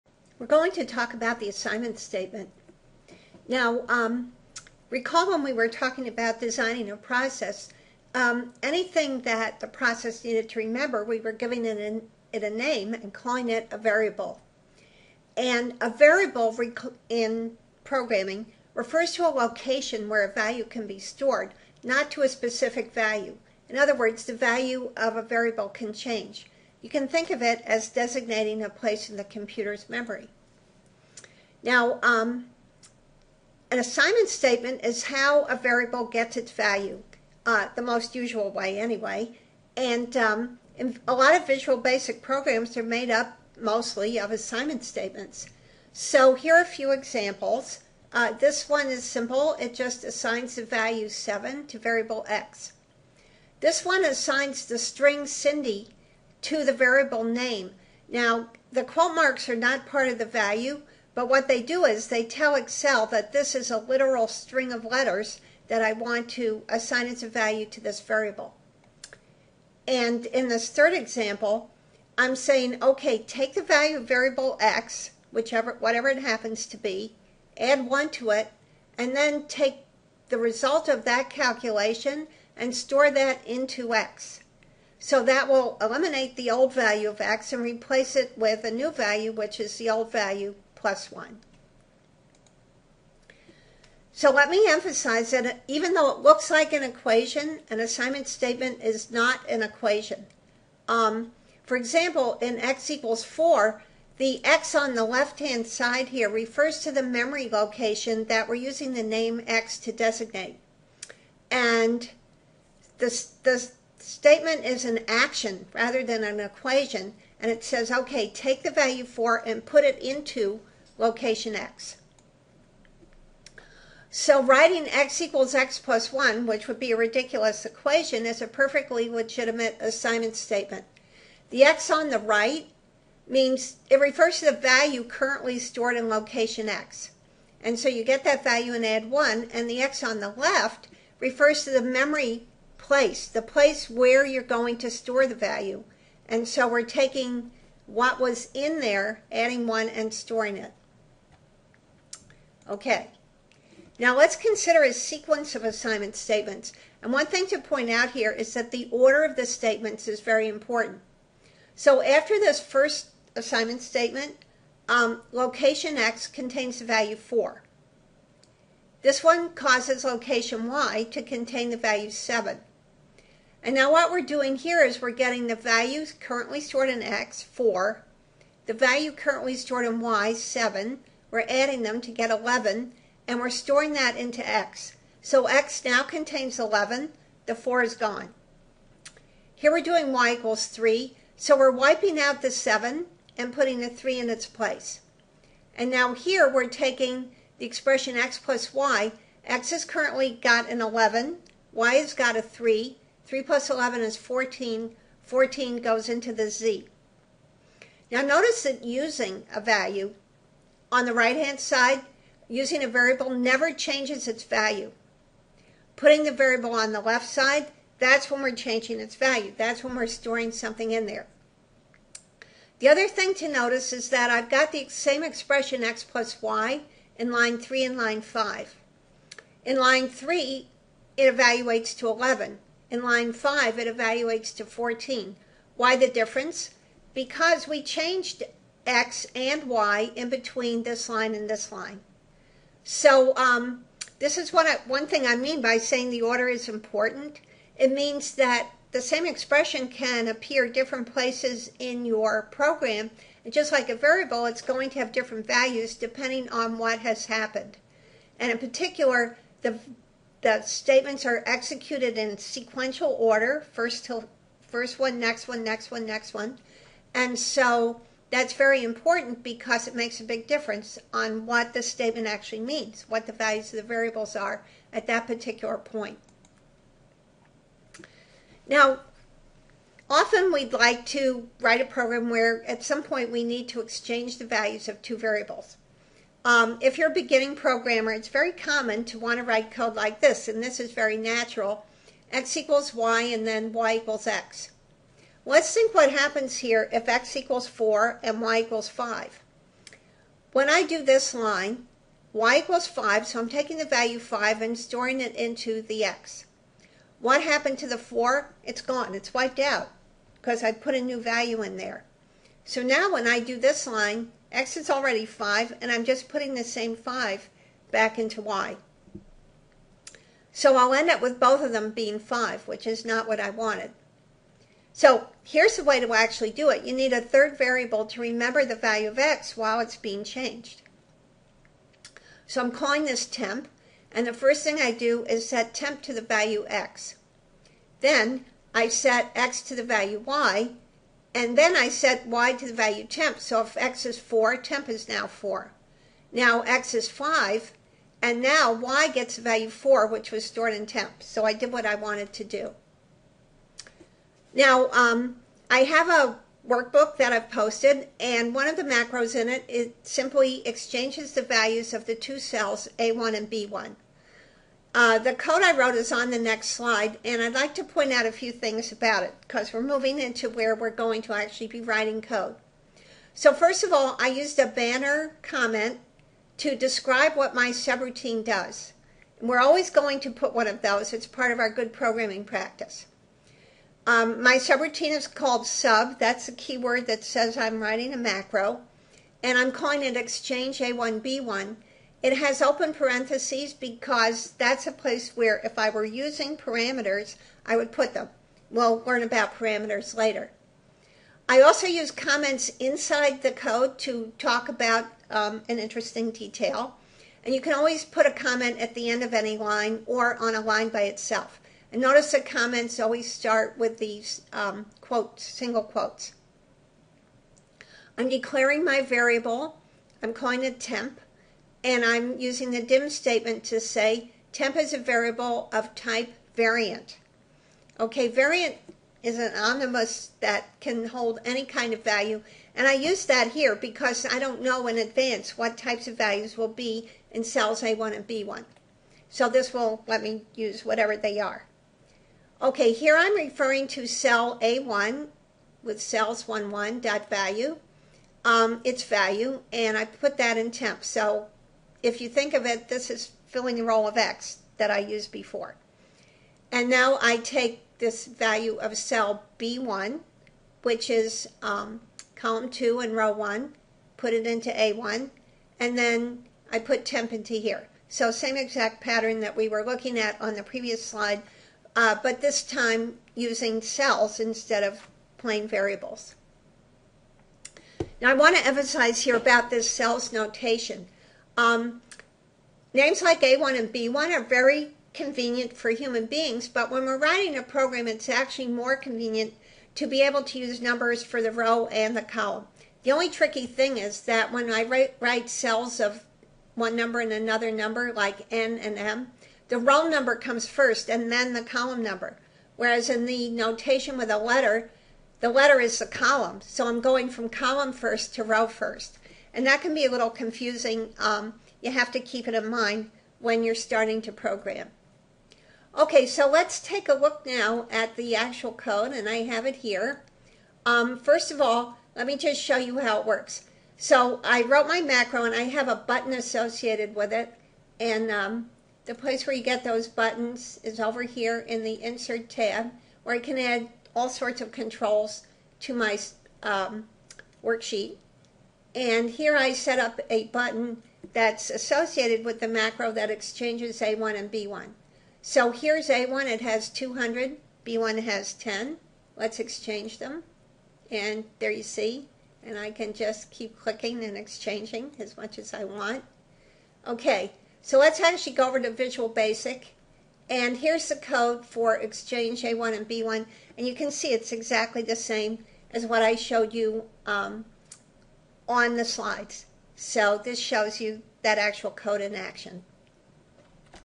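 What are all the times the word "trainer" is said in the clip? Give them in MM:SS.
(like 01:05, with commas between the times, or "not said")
not said.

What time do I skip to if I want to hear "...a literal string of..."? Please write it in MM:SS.
01:03.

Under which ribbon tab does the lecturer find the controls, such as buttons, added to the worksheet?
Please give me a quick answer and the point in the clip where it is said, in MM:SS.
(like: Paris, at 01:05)
Insert, at 08:52.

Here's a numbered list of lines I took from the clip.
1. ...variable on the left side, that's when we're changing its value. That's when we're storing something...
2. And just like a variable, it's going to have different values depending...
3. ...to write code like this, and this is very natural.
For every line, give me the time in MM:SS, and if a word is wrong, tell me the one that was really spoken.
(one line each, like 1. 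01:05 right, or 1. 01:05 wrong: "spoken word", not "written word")
1. 03:36 right
2. 04:13 right
3. 04:49 right.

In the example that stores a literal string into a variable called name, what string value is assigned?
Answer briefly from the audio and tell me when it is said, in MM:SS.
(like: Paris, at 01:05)
Cindy, at 00:55.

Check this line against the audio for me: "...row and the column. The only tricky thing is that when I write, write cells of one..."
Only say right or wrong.
right.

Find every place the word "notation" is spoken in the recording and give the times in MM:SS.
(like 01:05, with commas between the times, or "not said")
08:00, 08:23.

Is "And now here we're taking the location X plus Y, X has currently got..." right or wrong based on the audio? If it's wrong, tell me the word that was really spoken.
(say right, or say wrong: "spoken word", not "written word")
wrong: "expression", not "location".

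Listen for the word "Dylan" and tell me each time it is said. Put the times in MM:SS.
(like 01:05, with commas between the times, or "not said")
not said.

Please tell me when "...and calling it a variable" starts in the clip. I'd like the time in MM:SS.
00:12.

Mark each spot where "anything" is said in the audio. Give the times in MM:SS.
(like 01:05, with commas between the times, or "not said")
00:08.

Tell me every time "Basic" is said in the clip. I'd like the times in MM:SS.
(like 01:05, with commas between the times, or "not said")
00:41, 09:19.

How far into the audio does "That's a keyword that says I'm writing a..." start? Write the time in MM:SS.
06:26.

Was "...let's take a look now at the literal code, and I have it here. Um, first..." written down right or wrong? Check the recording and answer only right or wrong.
wrong.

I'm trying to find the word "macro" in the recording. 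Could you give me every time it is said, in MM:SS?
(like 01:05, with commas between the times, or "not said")
05:58, 06:28, 08:45, 09:02.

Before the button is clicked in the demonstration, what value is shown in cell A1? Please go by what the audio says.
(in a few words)
200.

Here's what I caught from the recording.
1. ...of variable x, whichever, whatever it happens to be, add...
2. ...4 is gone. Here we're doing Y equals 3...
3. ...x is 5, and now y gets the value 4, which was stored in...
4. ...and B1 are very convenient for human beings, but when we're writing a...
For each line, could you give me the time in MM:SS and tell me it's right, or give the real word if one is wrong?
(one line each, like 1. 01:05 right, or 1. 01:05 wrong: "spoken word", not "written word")
1. 01:13 right
2. 03:07 right
3. 05:46 right
4. 08:03 right.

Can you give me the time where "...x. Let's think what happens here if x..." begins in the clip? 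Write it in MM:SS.
04:54.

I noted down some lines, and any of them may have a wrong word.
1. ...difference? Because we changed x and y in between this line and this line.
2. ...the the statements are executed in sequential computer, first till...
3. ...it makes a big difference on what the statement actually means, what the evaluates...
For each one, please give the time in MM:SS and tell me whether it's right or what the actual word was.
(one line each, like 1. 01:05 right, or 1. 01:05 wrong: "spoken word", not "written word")
1. 03:56 right
2. 04:19 wrong: "order", not "computer"
3. 04:29 wrong: "values", not "evaluates".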